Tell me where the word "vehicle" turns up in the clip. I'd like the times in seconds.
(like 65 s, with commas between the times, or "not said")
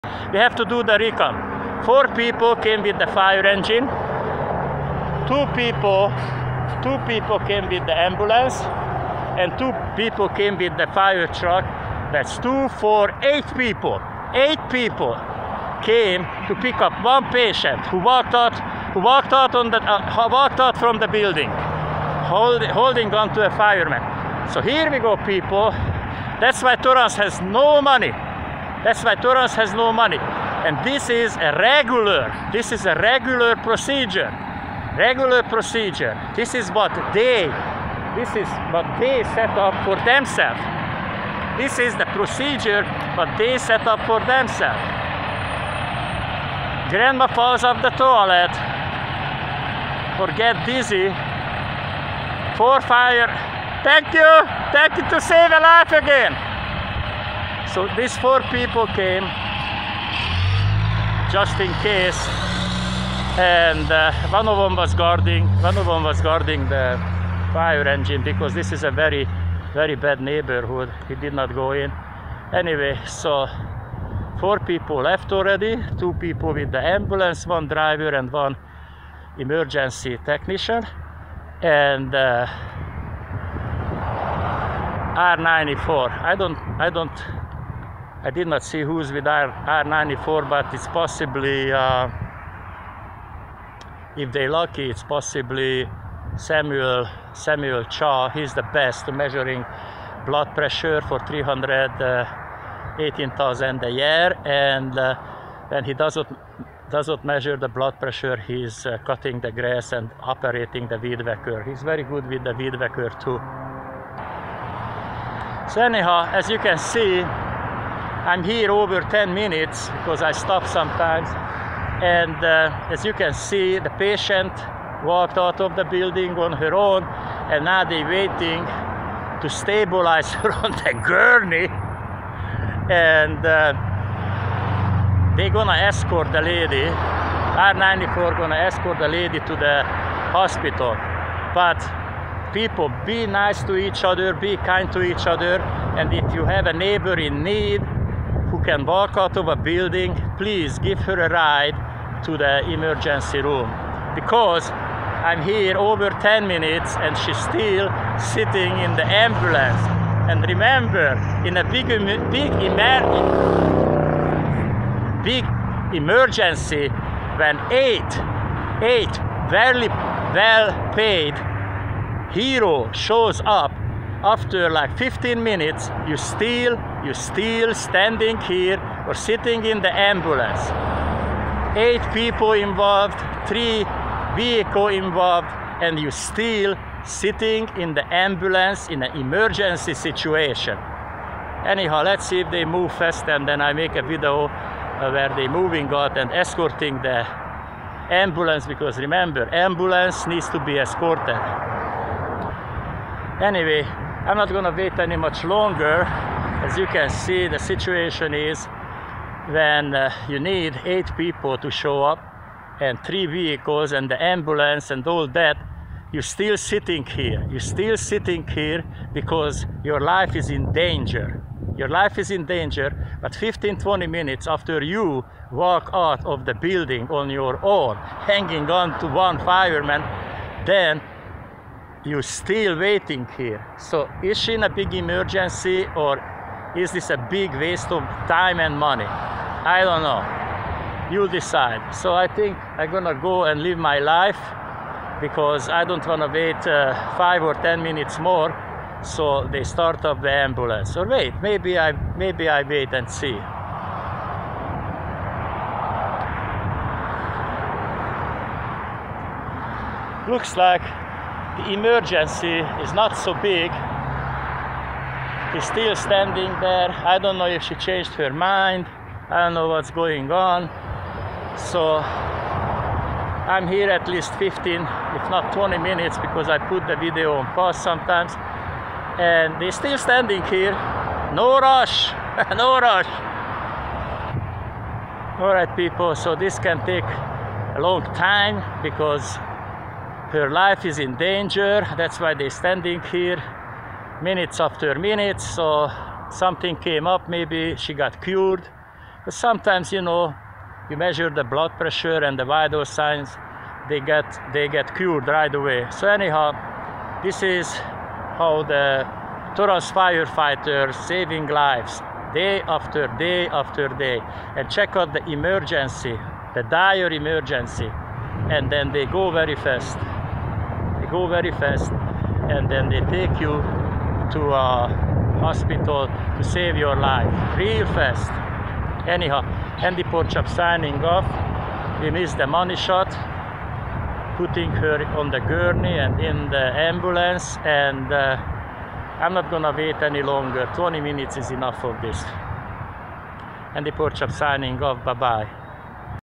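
184 s, 213 s.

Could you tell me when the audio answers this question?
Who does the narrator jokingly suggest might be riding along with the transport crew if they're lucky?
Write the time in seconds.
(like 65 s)
96 s.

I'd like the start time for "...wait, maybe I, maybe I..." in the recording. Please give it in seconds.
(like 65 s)
251 s.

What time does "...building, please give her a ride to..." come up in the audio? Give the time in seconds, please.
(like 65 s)
149 s.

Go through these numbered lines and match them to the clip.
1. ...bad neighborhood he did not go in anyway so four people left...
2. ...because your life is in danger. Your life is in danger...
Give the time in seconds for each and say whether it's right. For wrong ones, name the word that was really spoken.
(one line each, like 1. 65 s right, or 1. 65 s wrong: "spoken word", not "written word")
1. 69 s right
2. 219 s right.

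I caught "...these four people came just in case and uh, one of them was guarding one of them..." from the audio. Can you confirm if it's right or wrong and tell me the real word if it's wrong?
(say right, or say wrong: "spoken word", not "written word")
right.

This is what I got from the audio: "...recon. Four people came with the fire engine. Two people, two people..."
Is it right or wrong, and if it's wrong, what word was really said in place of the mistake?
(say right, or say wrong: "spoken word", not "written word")
right.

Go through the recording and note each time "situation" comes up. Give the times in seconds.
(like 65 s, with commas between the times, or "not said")
189 s, 207 s.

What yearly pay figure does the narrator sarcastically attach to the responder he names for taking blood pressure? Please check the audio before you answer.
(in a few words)
318,000.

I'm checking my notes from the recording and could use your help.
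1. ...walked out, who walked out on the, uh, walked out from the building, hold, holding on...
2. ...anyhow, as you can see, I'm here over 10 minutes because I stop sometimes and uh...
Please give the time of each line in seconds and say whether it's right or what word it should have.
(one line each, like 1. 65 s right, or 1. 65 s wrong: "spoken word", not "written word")
1. 17 s right
2. 115 s right.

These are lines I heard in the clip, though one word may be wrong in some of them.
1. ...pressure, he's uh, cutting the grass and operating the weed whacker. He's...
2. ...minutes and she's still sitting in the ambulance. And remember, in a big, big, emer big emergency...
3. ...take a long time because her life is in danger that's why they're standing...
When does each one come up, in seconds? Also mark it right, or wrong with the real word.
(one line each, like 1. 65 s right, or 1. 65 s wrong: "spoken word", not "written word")
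1. 107 s right
2. 156 s right
3. 286 s right.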